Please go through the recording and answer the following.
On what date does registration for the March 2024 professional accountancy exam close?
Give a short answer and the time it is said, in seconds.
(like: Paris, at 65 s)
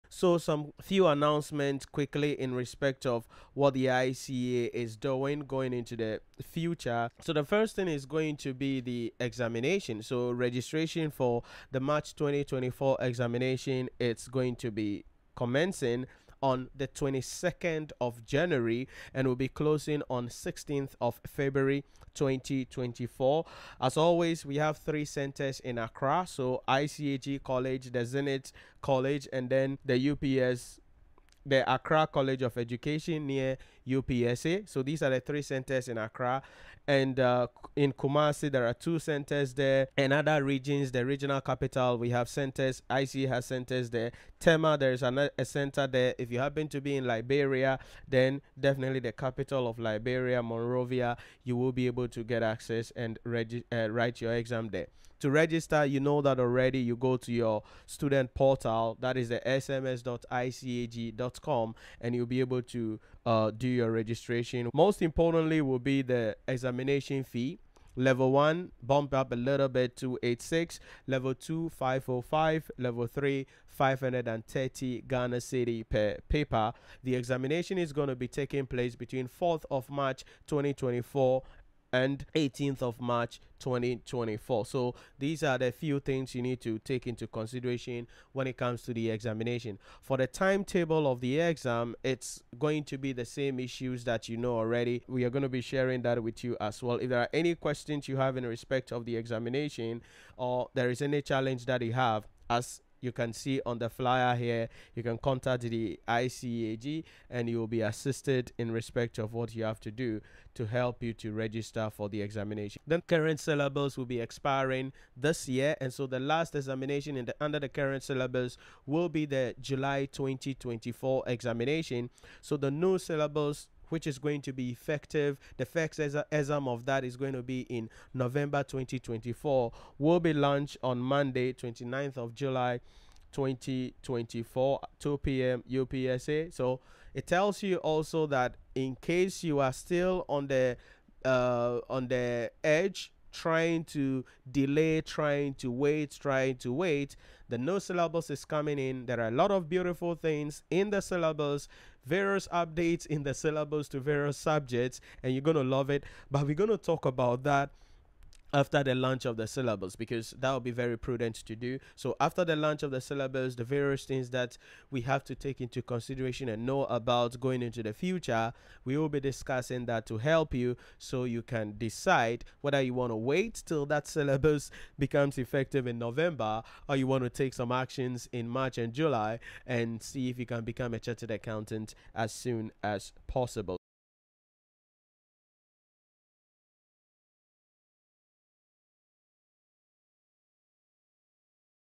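16th February 2024, at 20 s.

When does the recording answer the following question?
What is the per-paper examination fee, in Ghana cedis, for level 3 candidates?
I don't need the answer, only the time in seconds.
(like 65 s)
73 s.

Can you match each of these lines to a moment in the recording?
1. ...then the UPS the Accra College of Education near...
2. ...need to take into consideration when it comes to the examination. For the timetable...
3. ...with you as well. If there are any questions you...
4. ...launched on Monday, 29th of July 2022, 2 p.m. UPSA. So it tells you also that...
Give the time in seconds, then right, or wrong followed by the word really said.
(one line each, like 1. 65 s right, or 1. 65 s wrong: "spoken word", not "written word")
1. 29 s right
2. 86 s right
3. 96 s right
4. 130 s wrong: "2024", not "2022".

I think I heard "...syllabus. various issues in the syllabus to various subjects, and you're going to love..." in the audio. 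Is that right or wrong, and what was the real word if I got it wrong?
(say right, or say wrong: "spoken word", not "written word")
wrong: "updates", not "issues".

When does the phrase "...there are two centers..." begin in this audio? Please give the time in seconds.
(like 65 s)
38 s.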